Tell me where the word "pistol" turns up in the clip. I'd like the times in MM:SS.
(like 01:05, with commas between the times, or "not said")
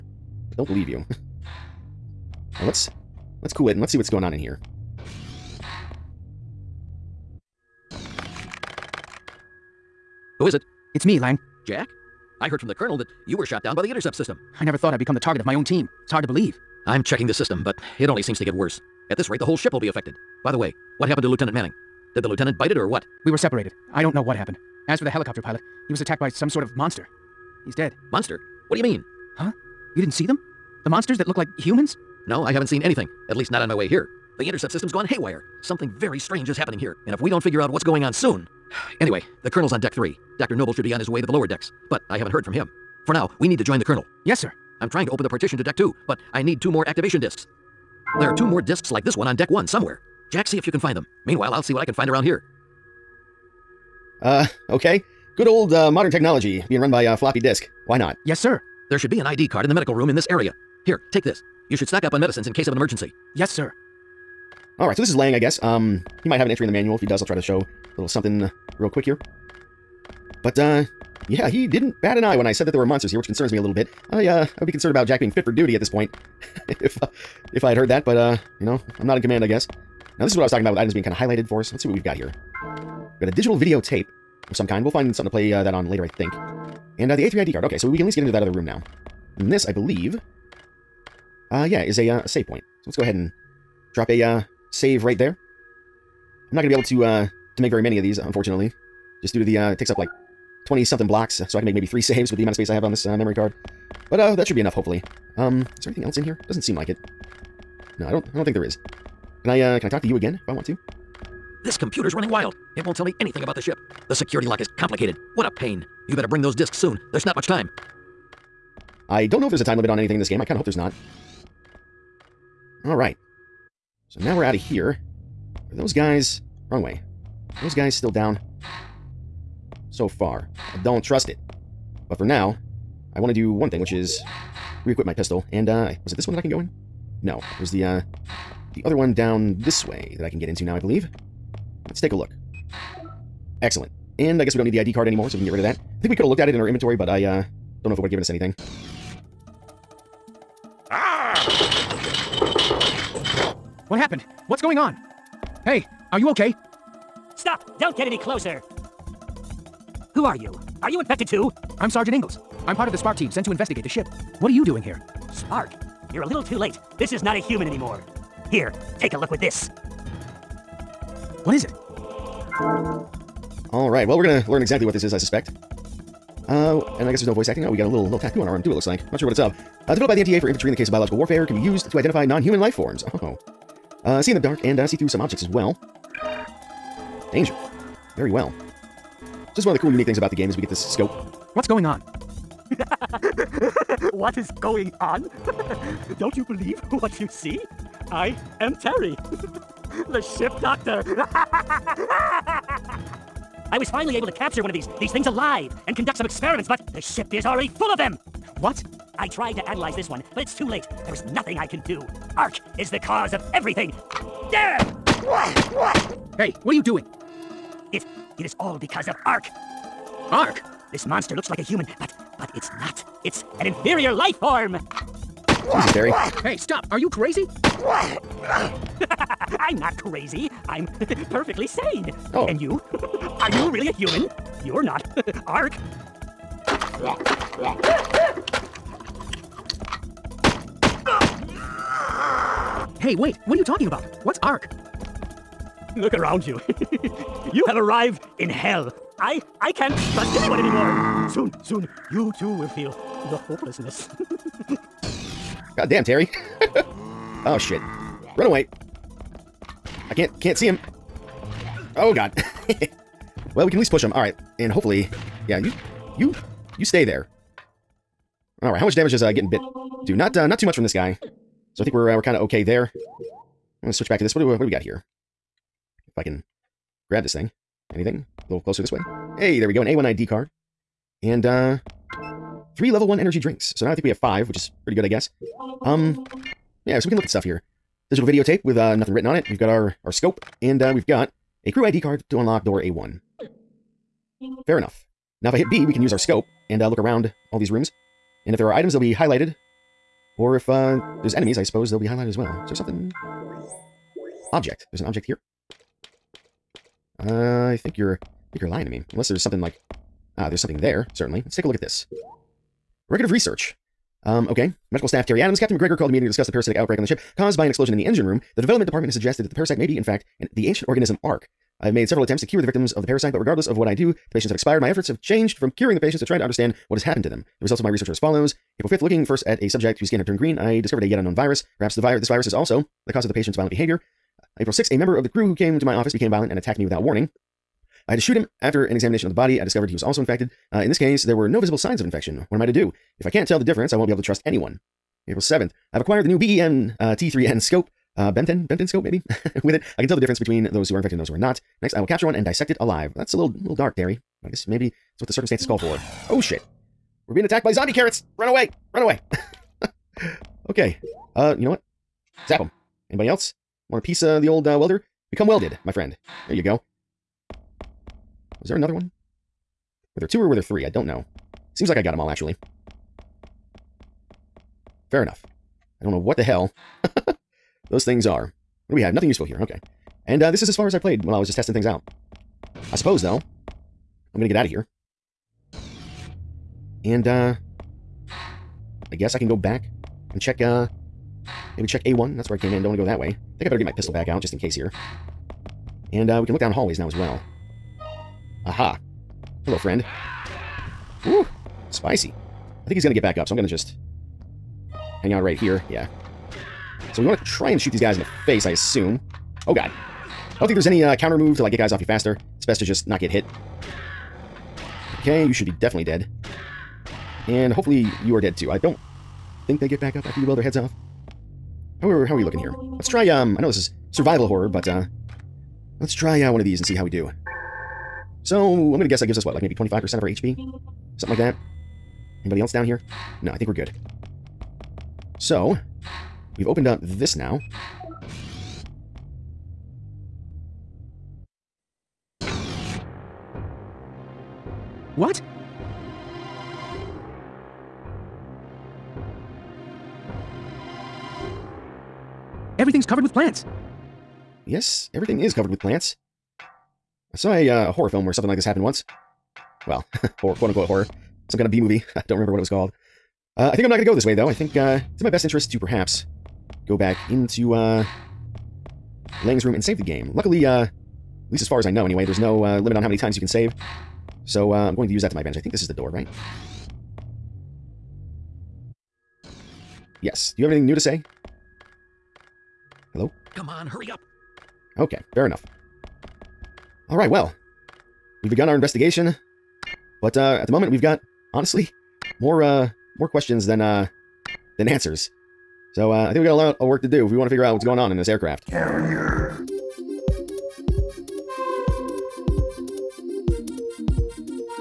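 02:15, 06:33.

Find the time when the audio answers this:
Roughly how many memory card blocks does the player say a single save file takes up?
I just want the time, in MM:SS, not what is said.
01:40.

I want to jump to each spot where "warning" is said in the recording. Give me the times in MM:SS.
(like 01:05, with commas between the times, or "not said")
05:37.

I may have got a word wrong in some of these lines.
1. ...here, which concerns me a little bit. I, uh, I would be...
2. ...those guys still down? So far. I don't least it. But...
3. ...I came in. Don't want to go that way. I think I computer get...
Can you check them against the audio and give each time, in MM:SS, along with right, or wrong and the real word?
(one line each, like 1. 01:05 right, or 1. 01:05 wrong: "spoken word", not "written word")
1. 01:13 right
2. 02:07 wrong: "trust", not "least"
3. 06:32 wrong: "better", not "computer".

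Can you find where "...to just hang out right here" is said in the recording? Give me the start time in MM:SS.
06:43.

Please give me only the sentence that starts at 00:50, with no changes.
Jack, see if you can find them.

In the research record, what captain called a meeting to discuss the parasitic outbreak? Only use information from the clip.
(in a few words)
Captain McGregor.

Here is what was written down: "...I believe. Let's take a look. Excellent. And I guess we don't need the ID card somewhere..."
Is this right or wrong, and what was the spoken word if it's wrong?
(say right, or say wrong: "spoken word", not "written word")
wrong: "anymore", not "somewhere".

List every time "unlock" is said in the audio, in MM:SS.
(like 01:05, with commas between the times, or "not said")
04:52.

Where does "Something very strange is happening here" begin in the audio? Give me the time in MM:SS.
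00:35.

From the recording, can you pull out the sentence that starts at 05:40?
Uh, in this case, there were no visible signs of infection.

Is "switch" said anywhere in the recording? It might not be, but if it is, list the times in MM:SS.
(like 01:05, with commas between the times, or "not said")
04:33.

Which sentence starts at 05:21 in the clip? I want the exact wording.
I have made several attempts to cure the victims of the parasite, but regardless of what I do, the patients have expired.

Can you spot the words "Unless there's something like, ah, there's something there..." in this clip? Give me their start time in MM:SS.
05:09.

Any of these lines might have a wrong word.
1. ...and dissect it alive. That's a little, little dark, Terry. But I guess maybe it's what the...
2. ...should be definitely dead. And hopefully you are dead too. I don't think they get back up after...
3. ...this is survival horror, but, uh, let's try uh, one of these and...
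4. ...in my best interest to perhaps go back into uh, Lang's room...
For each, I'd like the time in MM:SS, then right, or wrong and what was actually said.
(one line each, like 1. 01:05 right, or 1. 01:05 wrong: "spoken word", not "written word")
1. 05:52 right
2. 06:55 right
3. 07:03 right
4. 07:45 right.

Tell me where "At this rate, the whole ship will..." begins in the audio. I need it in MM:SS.
00:19.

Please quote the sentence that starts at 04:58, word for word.
And if there are items, they'll be highlighted.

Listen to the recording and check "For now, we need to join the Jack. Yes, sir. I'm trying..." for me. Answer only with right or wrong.
wrong.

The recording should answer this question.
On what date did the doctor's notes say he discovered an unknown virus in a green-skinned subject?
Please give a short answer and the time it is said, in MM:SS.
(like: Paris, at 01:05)
April 5th, at 05:28.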